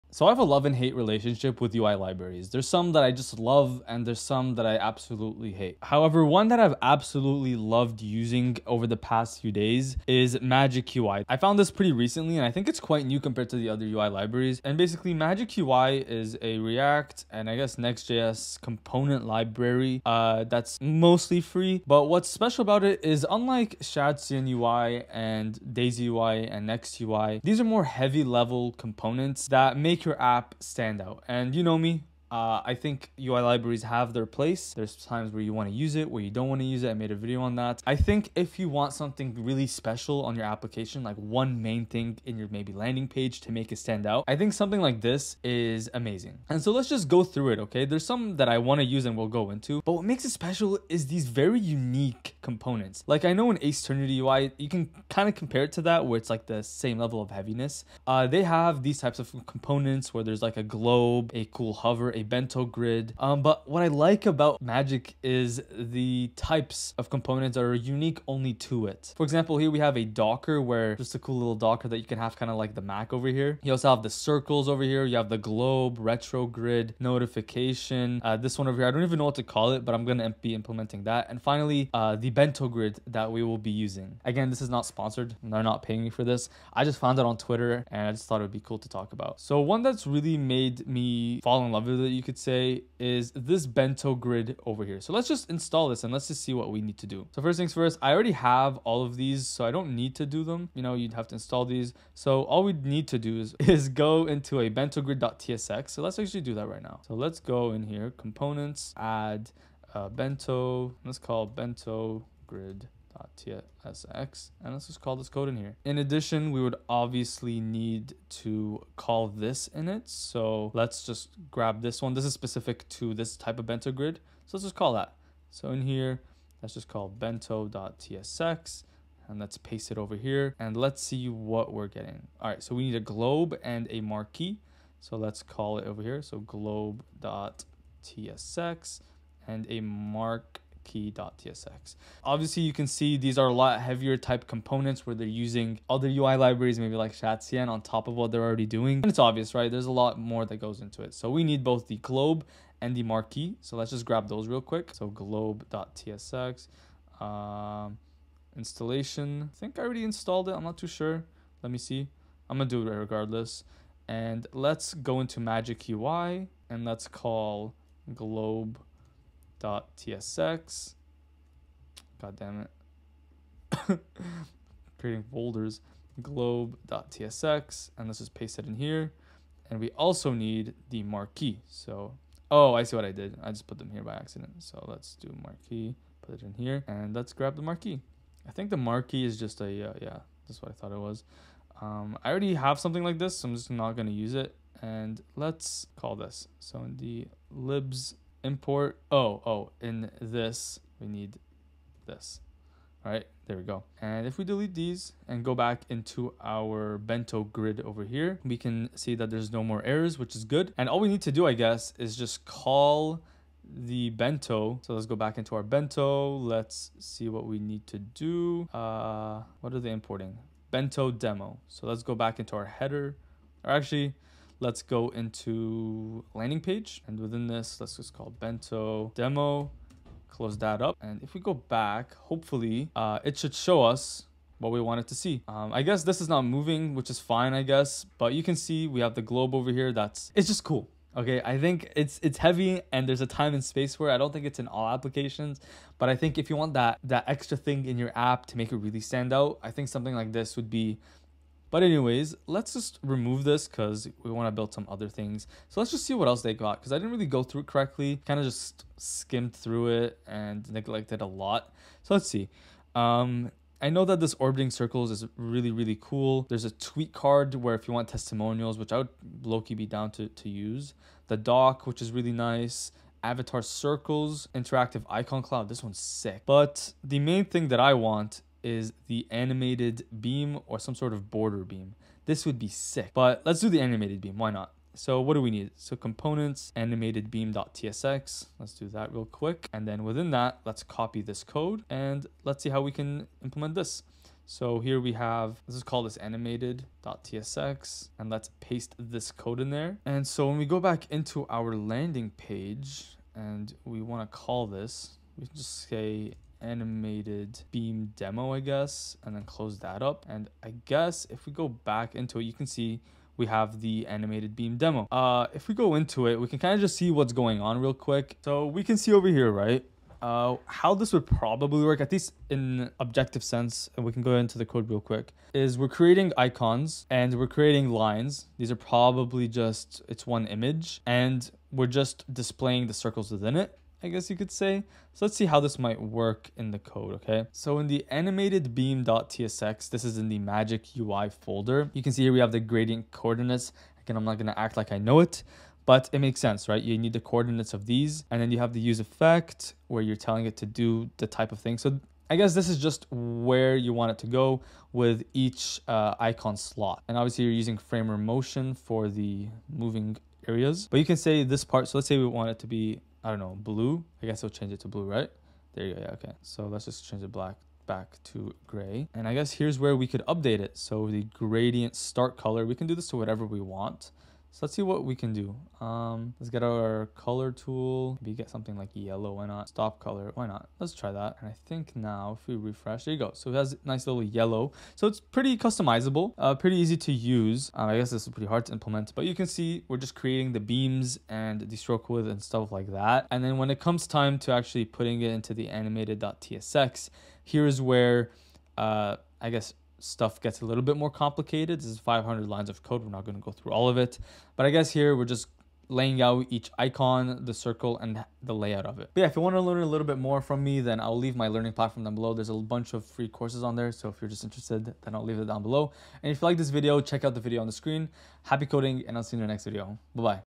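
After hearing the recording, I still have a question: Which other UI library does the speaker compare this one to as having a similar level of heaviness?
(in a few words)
Aceternity UI.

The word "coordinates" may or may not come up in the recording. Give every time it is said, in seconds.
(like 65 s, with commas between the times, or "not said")
343 s, 347 s.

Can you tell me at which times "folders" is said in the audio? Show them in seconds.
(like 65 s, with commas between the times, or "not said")
175 s, 341 s.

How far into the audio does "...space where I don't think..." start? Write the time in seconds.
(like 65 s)
243 s.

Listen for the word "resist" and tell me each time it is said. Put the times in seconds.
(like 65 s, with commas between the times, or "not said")
not said.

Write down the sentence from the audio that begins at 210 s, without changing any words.
And all we need to do, I guess, is just call the bento.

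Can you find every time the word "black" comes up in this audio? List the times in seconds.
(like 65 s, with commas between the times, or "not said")
367 s.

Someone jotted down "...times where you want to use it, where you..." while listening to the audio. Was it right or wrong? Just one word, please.
right.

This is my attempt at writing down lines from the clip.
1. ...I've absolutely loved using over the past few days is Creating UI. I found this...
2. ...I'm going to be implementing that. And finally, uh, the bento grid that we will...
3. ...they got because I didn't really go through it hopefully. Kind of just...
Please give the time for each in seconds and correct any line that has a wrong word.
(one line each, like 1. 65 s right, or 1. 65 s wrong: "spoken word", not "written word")
1. 6 s wrong: "Magic", not "Creating"
2. 79 s right
3. 256 s wrong: "correctly", not "hopefully".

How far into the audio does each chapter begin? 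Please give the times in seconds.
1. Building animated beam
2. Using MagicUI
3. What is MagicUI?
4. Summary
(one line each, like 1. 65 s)
1. 264 s
2. 97 s
3. 23 s
4. 400 s.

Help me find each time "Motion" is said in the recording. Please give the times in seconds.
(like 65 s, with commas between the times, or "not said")
358 s.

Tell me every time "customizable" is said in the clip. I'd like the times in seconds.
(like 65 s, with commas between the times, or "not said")
385 s.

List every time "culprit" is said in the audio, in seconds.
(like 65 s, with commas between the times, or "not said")
not said.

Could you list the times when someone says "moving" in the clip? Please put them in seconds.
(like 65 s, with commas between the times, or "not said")
236 s, 359 s.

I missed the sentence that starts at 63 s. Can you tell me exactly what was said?
Um, but what I like about Magic is the types of components that are unique only to it.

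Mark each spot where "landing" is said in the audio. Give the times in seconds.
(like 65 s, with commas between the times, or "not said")
42 s, 226 s, 301 s.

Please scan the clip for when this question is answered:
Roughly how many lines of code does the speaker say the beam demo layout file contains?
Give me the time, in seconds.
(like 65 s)
401 s.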